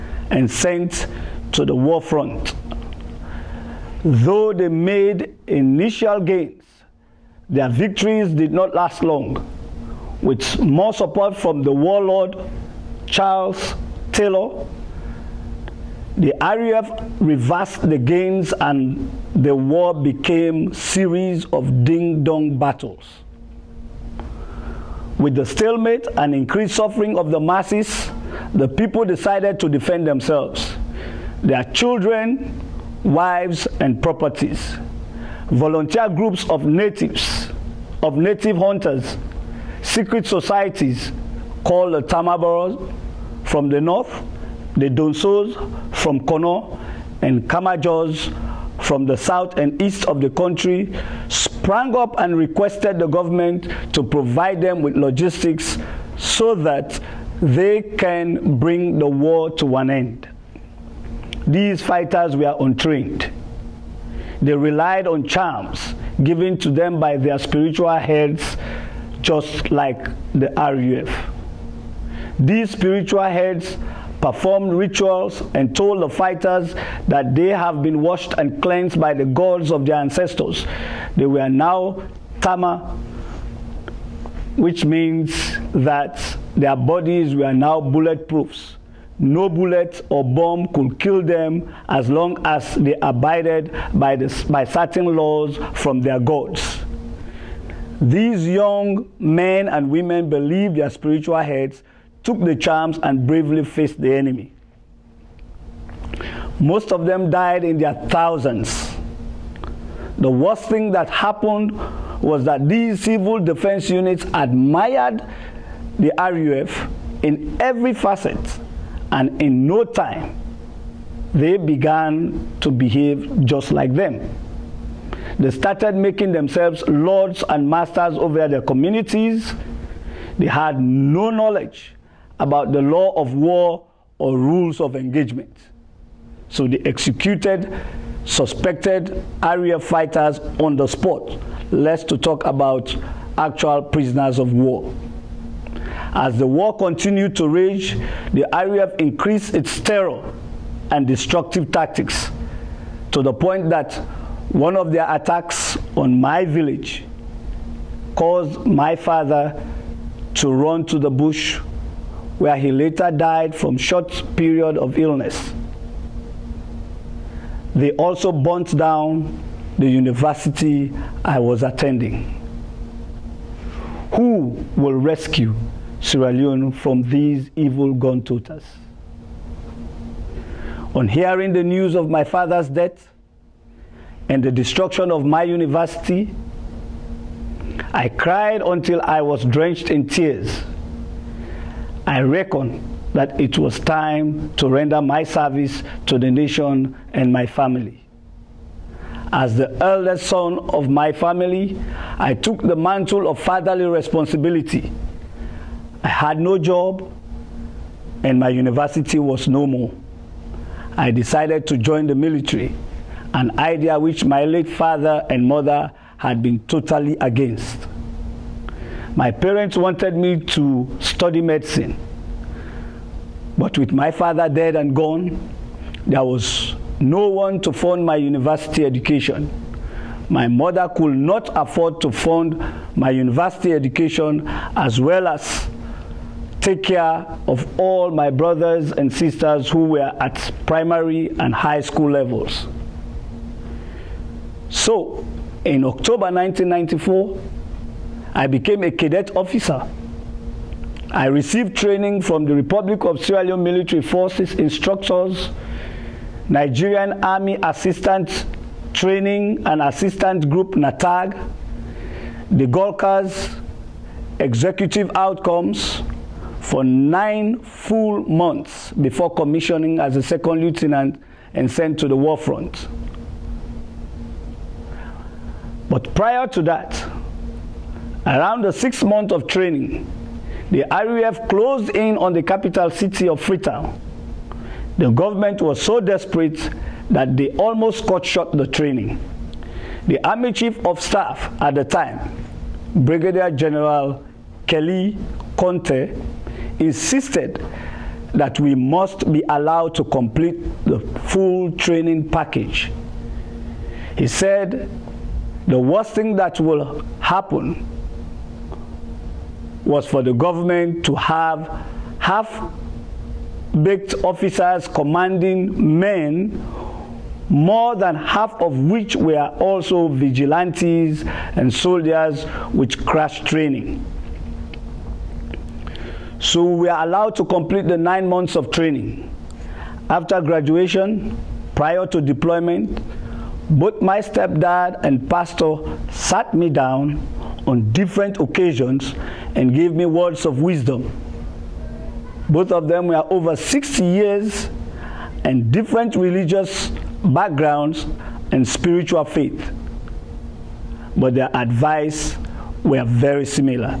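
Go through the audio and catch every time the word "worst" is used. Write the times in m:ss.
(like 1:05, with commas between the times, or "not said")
1:50, 5:05.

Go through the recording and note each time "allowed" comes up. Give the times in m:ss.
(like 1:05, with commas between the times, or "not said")
4:59, 5:27.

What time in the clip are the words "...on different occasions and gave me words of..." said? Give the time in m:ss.
5:37.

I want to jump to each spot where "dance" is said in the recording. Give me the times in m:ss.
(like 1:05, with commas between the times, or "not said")
not said.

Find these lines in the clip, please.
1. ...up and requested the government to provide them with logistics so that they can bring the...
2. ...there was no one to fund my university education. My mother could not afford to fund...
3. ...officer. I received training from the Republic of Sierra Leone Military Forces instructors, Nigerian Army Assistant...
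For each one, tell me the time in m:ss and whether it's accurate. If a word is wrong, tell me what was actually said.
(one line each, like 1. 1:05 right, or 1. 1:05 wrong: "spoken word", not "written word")
1. 0:51 right
2. 3:46 right
3. 4:09 right.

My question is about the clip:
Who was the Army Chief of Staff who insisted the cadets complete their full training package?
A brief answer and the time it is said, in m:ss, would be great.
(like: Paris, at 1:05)
Kellie Conteh, at 4:54.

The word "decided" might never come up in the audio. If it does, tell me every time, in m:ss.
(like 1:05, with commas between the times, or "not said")
0:29, 3:31.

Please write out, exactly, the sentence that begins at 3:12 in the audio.
I reckon that it was time to render my service to the nation and my family.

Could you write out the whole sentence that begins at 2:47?
They also burnt down the university I was attending.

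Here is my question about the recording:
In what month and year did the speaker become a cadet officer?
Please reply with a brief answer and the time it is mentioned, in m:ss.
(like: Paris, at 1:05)
October 1994, at 4:05.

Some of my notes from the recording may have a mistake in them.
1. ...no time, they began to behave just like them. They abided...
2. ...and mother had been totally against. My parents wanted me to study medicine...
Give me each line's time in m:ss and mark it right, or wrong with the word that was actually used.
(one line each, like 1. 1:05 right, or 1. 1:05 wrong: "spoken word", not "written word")
1. 1:59 wrong: "started", not "abided"
2. 3:35 right.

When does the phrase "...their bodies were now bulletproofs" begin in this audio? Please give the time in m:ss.
1:26.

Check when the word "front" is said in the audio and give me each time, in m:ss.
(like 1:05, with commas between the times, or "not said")
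0:02, 4:32.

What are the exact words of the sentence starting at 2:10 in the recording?
They had no knowledge about the law of war or rules of engagement.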